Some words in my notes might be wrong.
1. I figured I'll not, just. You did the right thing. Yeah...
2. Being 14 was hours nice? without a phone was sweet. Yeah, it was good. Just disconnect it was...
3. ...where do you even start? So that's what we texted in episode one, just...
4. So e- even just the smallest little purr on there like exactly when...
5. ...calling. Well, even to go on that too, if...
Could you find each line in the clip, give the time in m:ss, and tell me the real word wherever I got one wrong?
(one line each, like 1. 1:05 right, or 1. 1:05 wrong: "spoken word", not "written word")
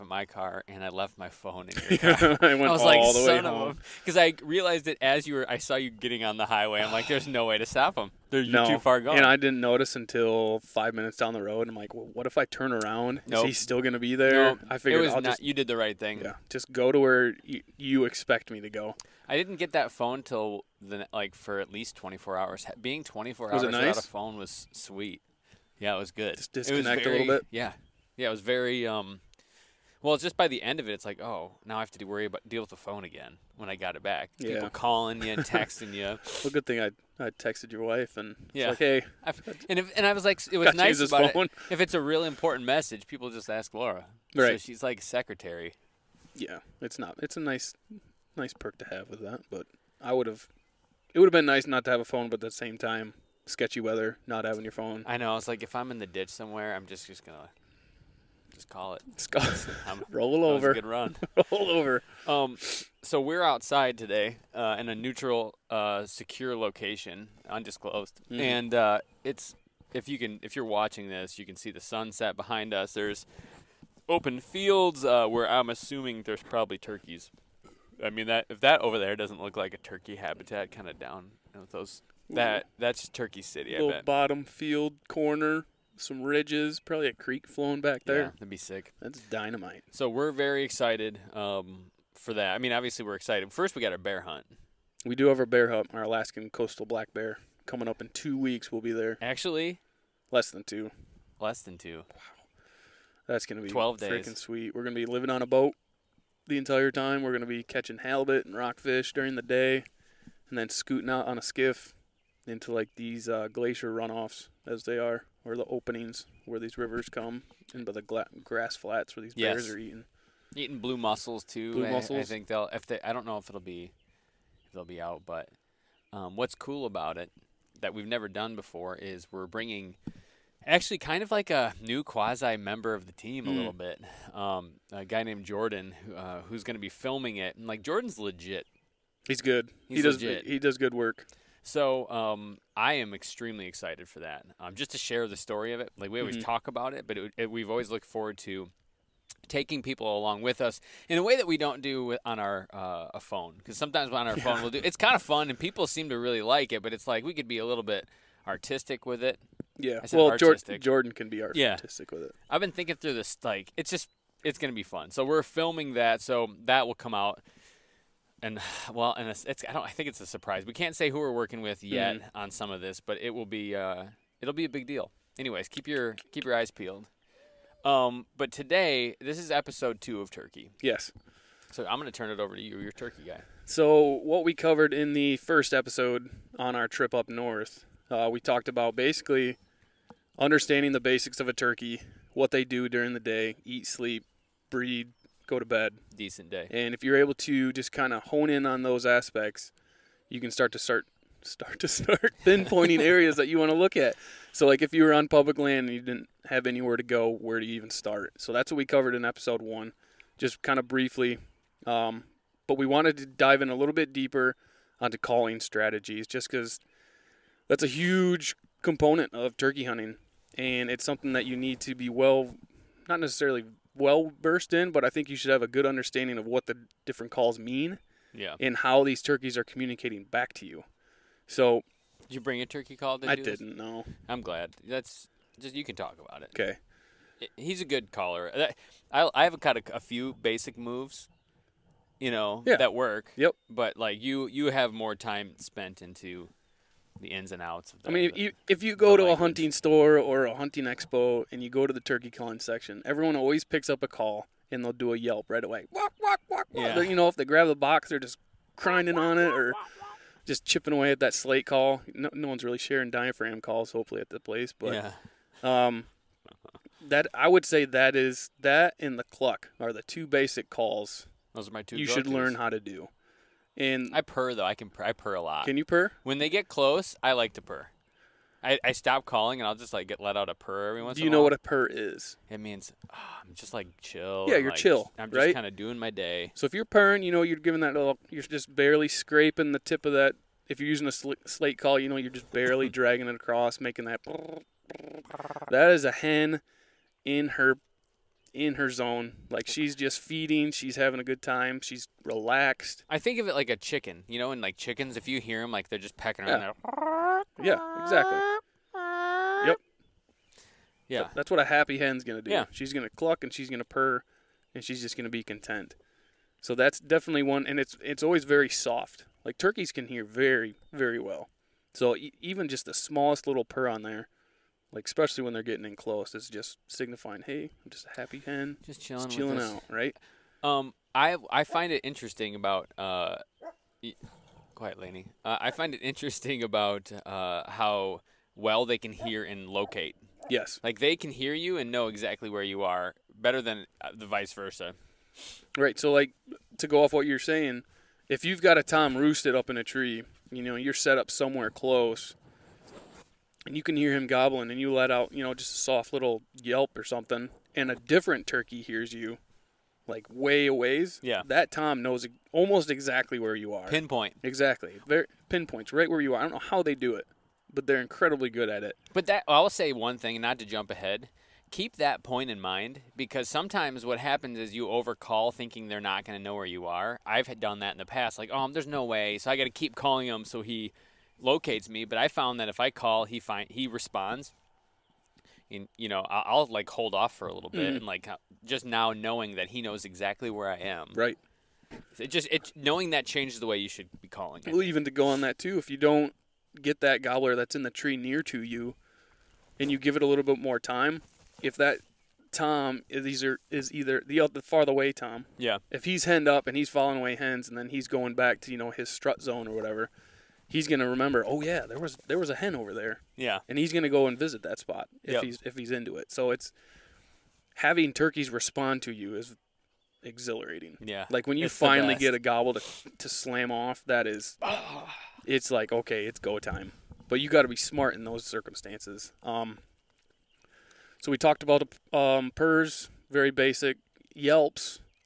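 1. 0:14 right
2. 0:22 wrong: "24", not "14"
3. 3:27 wrong: "covered", not "texted"
4. 5:21 wrong: "especially", not "exactly"
5. 6:34 right.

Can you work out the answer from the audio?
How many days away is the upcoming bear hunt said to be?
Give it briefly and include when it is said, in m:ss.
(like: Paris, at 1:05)
12, at 1:43.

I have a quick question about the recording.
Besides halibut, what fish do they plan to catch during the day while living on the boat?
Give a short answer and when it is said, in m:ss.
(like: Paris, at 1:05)
Rockfish, at 1:48.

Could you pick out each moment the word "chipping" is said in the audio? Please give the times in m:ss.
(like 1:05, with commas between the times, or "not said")
4:20.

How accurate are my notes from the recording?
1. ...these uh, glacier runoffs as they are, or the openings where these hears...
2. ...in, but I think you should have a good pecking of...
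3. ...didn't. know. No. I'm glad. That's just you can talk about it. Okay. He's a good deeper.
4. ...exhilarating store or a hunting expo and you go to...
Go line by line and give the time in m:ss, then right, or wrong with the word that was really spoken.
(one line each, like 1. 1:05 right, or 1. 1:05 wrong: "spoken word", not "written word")
1. 1:52 wrong: "rivers", not "hears"
2. 3:44 wrong: "understanding", not "pecking"
3. 3:53 wrong: "caller", not "deeper"
4. 4:09 wrong: "hunting", not "exhilarating".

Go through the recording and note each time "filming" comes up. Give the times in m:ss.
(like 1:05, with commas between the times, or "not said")
2:16, 2:45.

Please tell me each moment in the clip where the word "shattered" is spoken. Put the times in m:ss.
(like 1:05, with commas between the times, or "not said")
not said.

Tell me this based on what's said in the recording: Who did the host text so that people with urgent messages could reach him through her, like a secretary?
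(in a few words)
Laura.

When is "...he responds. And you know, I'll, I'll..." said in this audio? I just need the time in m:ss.
6:23.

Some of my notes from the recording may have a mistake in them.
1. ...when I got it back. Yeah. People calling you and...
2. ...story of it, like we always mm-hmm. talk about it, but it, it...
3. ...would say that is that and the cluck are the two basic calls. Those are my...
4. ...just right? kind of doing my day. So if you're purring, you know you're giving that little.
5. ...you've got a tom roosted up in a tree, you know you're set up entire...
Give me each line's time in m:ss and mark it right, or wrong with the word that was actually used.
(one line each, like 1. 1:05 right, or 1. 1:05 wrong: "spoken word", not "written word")
1. 0:33 right
2. 2:25 right
3. 4:27 right
4. 4:45 right
5. 5:48 wrong: "somewhere", not "entire".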